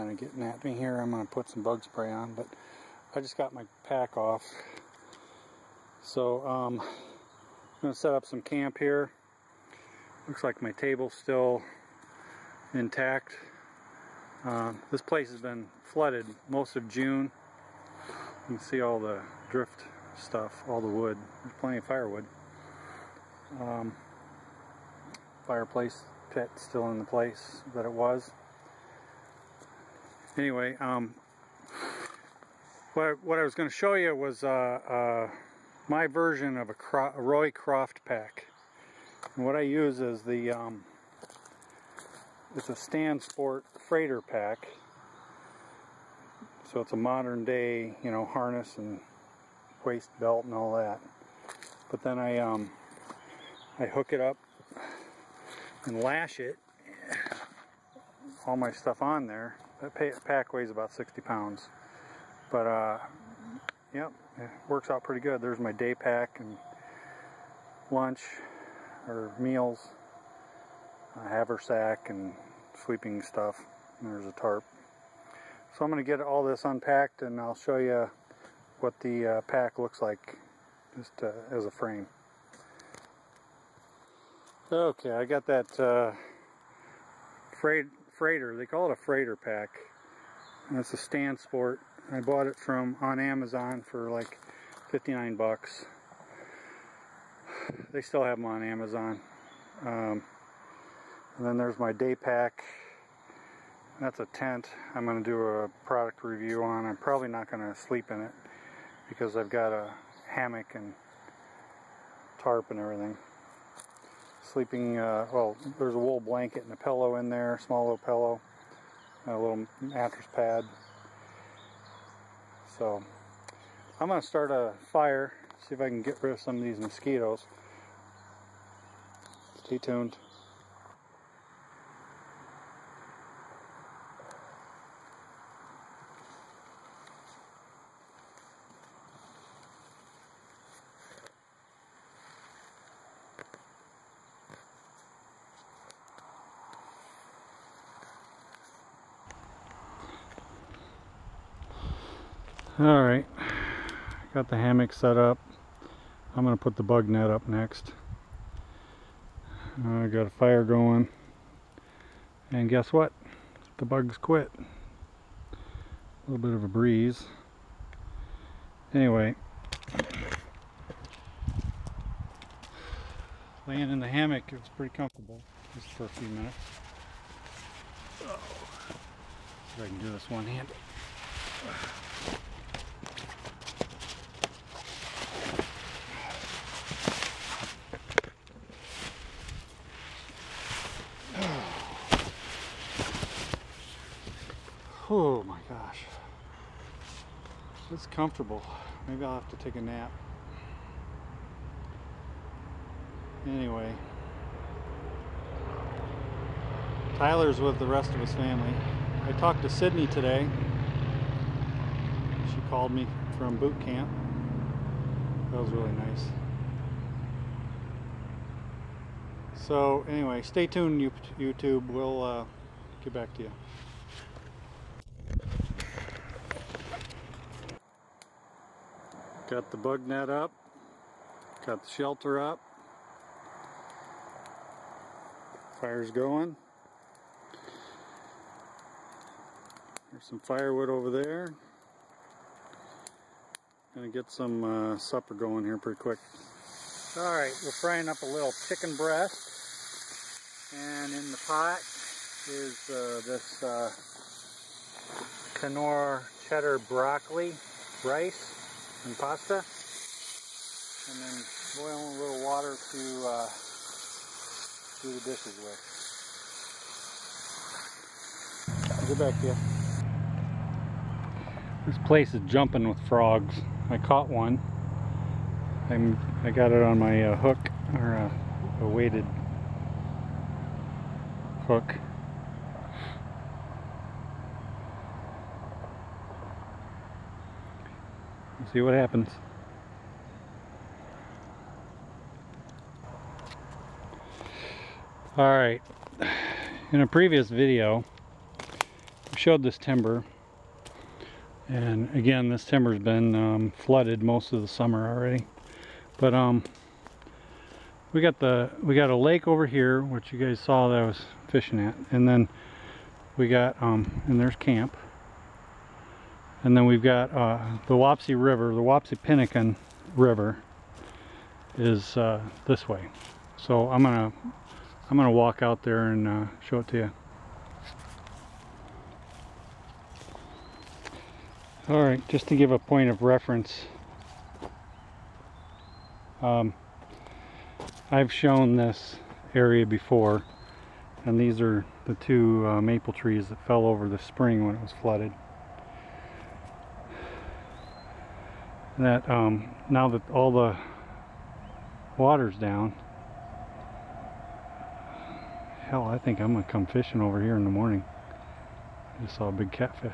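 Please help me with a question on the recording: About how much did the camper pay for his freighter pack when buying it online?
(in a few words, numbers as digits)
$59.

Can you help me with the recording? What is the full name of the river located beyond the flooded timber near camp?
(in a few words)
Wapsipinicon River.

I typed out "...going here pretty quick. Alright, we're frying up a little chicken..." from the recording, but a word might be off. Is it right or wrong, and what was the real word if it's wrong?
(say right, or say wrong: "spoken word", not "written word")
right.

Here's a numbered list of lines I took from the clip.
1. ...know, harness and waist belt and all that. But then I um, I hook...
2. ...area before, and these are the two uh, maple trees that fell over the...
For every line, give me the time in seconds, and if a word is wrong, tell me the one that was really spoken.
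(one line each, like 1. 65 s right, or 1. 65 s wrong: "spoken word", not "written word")
1. 48 s right
2. 339 s right.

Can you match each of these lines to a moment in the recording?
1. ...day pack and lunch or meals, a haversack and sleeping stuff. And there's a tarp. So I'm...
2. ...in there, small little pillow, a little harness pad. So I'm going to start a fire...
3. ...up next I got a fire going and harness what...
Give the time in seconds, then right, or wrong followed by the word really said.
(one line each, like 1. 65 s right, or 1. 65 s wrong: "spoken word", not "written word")
1. 65 s right
2. 117 s wrong: "mattress", not "harness"
3. 157 s wrong: "guess", not "harness".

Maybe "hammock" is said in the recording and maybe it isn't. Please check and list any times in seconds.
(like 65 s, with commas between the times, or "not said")
110 s, 154 s, 174 s.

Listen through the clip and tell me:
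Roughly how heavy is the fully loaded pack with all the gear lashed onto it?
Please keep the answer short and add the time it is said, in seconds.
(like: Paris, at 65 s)
60 pounds, at 60 s.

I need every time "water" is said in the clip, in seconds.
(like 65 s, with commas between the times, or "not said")
262 s, 352 s.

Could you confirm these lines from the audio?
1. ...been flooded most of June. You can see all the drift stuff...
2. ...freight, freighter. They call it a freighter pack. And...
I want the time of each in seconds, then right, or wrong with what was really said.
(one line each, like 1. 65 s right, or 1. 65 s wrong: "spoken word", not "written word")
1. 15 s right
2. 87 s right.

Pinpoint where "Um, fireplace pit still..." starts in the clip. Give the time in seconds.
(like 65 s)
23 s.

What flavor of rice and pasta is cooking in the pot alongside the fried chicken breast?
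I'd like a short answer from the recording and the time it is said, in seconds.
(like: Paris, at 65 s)
cheddar broccoli, at 256 s.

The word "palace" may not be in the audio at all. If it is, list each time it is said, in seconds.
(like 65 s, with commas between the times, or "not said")
not said.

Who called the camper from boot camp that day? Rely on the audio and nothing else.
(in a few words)
Sydney.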